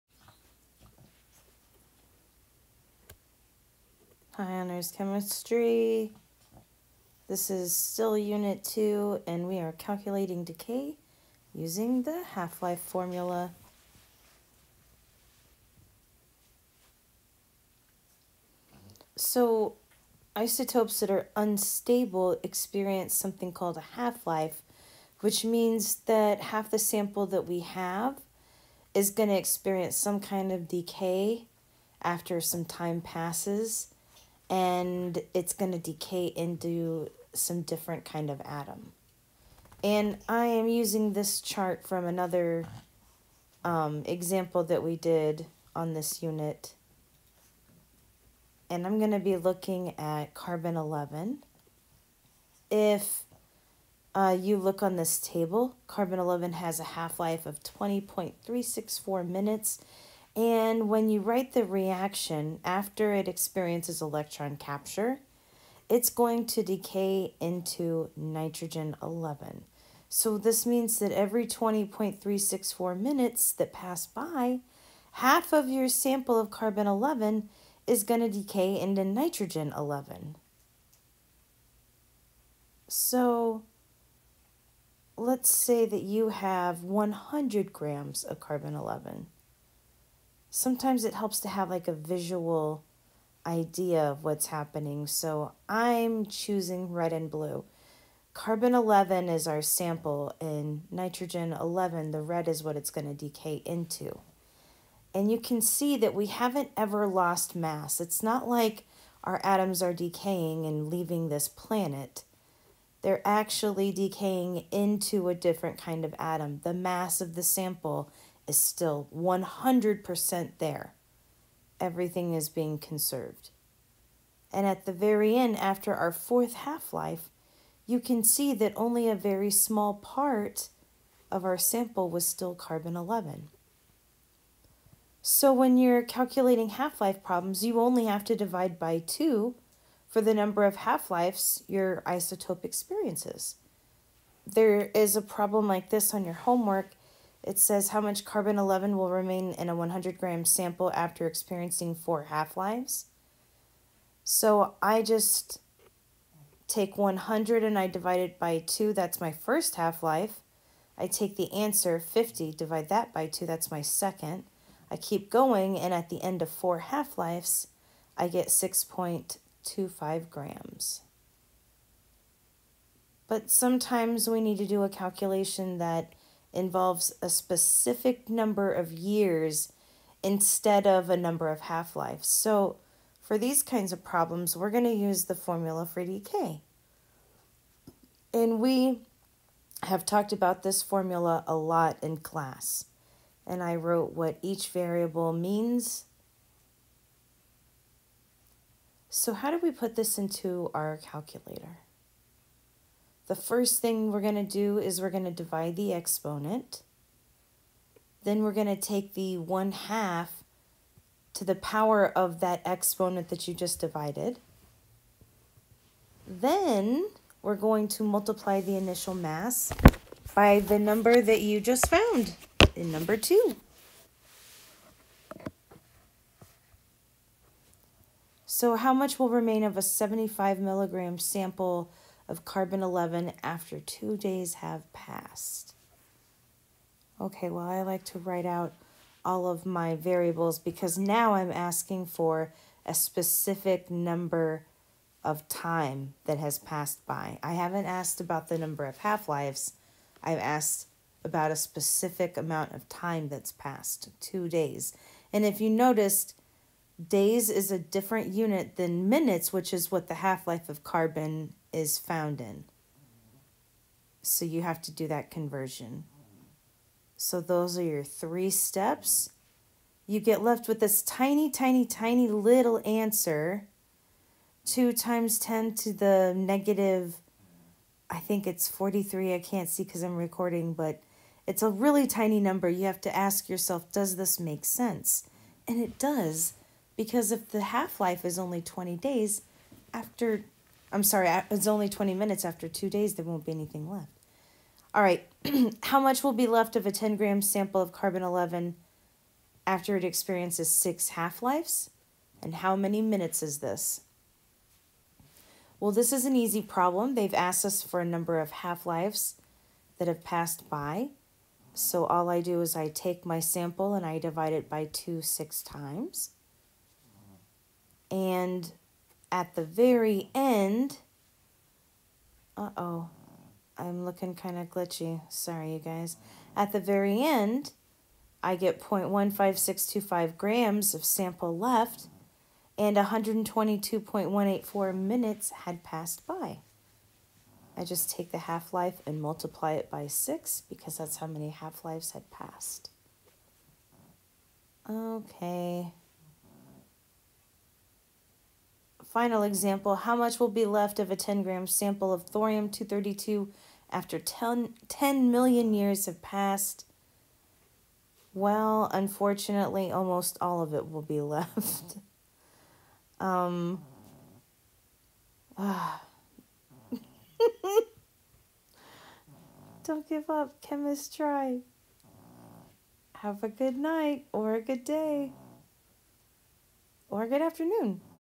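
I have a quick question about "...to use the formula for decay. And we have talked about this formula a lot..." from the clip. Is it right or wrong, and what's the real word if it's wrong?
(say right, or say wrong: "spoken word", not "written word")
right.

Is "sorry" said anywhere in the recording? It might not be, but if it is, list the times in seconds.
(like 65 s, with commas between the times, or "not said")
291 s, 325 s.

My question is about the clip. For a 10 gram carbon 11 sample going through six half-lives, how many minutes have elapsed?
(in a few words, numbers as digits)
122.184 minutes.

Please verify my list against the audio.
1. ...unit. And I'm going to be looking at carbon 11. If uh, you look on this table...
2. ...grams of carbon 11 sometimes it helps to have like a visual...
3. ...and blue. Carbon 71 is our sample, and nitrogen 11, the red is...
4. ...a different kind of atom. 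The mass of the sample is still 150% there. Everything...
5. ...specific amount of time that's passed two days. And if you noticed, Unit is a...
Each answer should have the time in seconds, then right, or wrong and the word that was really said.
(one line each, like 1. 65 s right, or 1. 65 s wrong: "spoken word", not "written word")
1. 46 s right
2. 87 s right
3. 97 s wrong: "11", not "71"
4. 115 s wrong: "100", not "150"
5. 251 s wrong: "Days", not "Unit".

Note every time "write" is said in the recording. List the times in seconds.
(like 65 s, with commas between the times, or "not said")
61 s, 238 s.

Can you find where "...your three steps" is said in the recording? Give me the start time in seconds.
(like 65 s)
267 s.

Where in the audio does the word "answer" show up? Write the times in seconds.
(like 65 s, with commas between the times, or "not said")
161 s, 272 s.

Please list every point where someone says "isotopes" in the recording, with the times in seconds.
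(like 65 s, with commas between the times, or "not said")
20 s, 142 s.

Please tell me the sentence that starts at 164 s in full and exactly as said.
I keep going, and at the end of four half lives, I get 6.25 grams.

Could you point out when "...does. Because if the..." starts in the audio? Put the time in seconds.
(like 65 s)
285 s.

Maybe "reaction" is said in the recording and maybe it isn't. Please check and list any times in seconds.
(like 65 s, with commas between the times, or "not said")
61 s.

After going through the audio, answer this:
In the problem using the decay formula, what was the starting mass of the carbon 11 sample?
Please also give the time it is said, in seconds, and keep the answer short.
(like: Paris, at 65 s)
75 milligrams, at 229 s.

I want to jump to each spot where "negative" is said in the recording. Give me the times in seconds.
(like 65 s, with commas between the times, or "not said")
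276 s.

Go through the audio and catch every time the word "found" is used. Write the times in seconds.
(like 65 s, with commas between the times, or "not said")
221 s, 261 s.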